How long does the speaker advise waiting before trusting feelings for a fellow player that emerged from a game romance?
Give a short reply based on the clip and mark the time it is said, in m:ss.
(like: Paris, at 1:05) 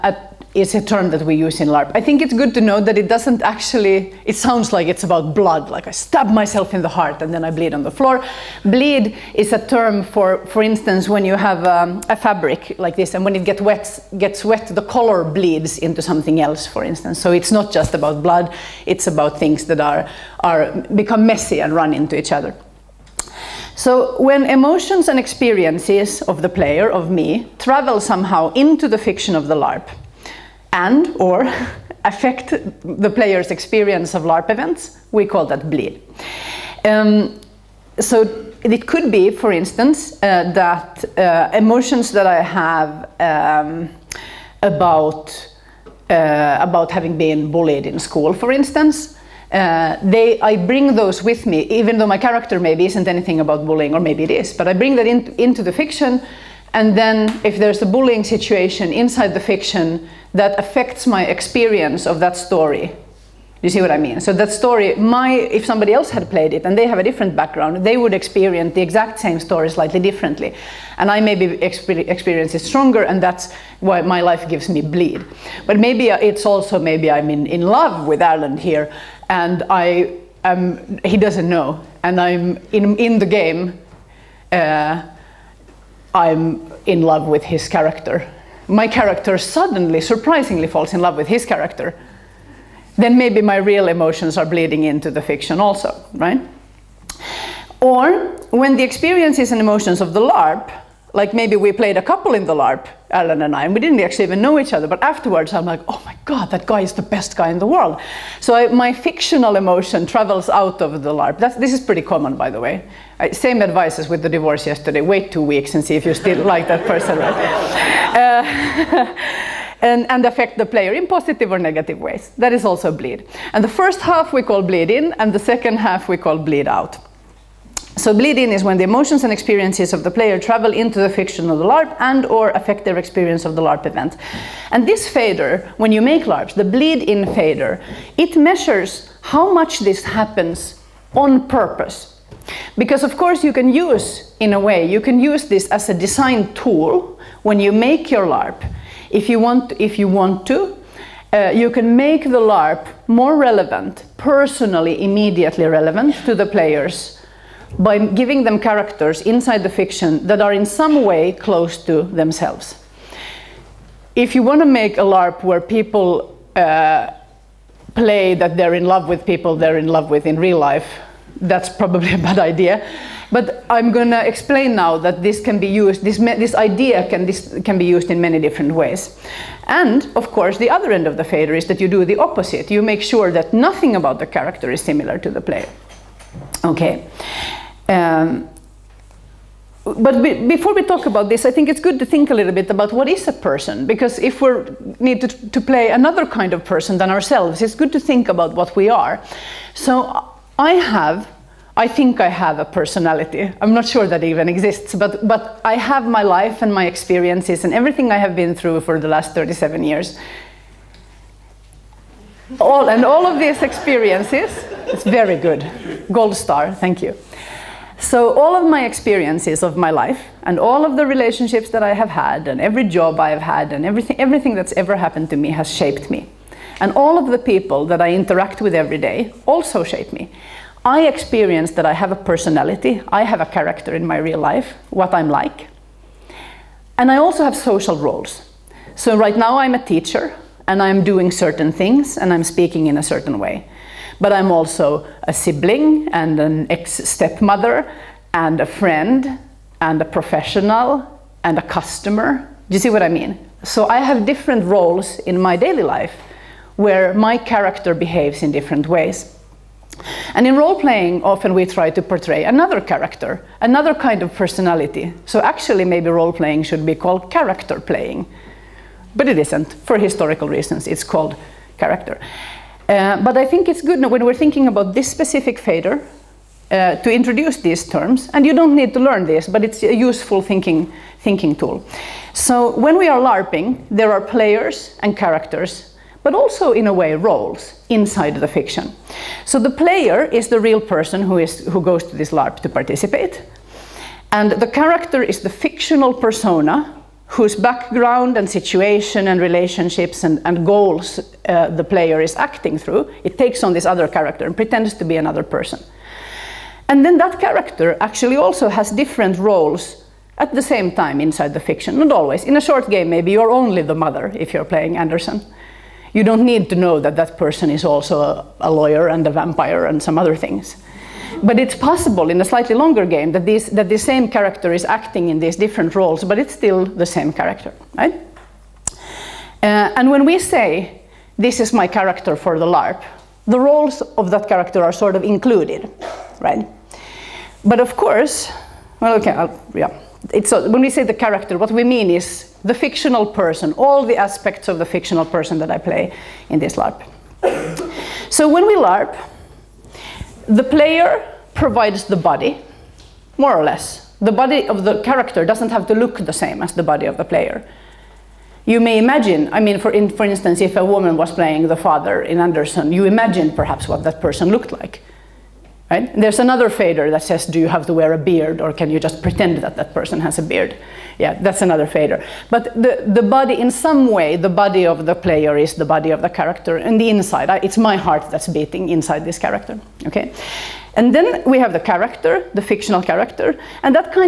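two weeks, at 1:55.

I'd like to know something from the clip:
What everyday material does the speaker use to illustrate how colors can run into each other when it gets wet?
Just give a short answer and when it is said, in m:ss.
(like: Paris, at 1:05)
fabric, at 0:12.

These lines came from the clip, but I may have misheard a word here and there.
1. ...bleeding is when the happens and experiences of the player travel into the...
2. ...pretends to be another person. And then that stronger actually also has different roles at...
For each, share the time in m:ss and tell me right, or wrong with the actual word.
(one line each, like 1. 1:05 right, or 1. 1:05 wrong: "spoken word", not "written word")
1. 2:08 wrong: "emotions", not "happens"
2. 5:04 wrong: "character", not "stronger".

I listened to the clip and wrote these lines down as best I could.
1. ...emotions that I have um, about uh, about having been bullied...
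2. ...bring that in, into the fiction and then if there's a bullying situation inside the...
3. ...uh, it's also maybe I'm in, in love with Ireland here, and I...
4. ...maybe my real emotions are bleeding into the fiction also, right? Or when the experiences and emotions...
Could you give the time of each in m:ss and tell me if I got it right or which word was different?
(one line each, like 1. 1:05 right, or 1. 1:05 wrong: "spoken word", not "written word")
1. 0:41 right
2. 0:54 right
3. 1:16 right
4. 1:33 right.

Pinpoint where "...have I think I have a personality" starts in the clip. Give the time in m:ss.
3:20.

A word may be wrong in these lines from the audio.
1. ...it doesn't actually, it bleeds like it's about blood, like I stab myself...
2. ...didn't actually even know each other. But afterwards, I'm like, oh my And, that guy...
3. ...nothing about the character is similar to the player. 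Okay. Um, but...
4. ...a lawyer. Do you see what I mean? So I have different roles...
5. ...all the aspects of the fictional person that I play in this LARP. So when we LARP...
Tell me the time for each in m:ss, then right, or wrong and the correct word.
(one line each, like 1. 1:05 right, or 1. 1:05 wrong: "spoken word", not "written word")
1. 0:02 wrong: "sounds", not "bleeds"
2. 1:43 wrong: "God", not "And"
3. 3:03 right
4. 4:11 wrong: "customer", not "lawyer"
5. 5:43 right.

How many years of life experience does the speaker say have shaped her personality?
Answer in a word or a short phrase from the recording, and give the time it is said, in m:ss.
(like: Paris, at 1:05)
37, at 3:29.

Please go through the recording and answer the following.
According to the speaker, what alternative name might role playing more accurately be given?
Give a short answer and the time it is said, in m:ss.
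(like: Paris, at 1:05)
character playing, at 4:27.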